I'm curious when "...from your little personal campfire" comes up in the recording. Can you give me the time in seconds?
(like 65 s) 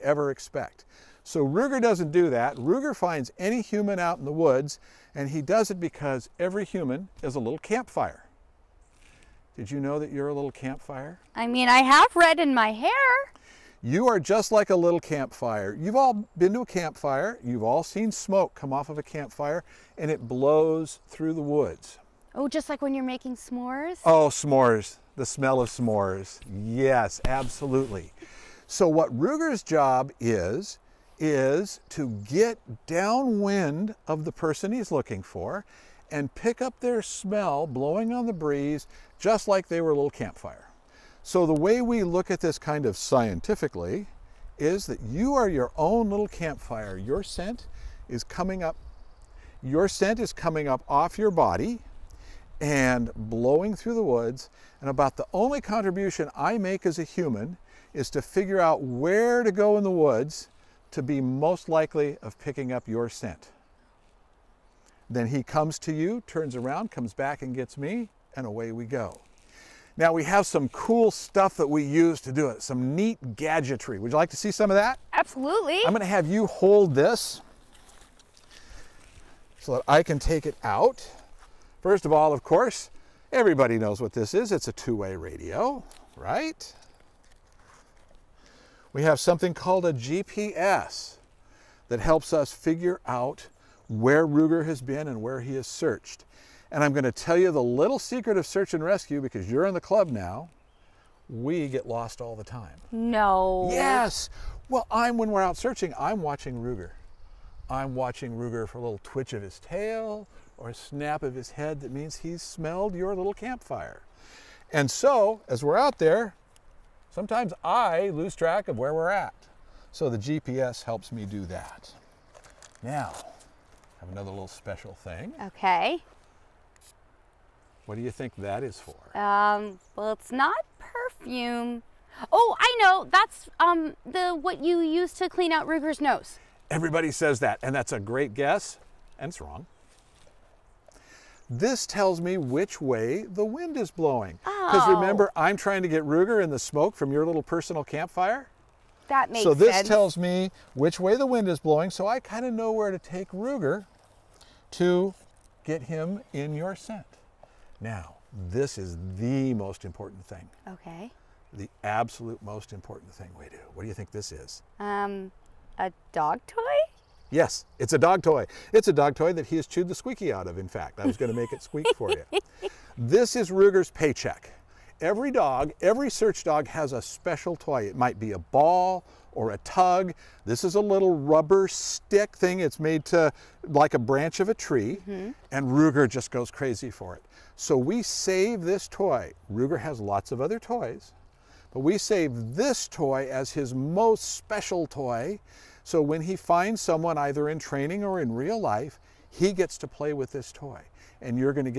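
146 s.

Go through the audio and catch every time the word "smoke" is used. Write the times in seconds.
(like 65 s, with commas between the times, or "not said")
18 s, 146 s.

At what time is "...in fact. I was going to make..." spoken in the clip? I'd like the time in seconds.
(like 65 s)
170 s.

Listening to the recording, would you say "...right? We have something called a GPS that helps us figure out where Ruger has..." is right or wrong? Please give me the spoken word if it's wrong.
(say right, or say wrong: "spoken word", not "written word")
right.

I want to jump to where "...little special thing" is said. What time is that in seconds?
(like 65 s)
124 s.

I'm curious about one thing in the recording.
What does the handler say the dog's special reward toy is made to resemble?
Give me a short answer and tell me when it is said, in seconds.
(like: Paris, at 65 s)
A branch of a tree, at 183 s.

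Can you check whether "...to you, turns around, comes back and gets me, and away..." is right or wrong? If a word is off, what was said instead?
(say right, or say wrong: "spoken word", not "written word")
right.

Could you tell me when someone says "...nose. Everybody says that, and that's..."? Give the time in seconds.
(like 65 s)
135 s.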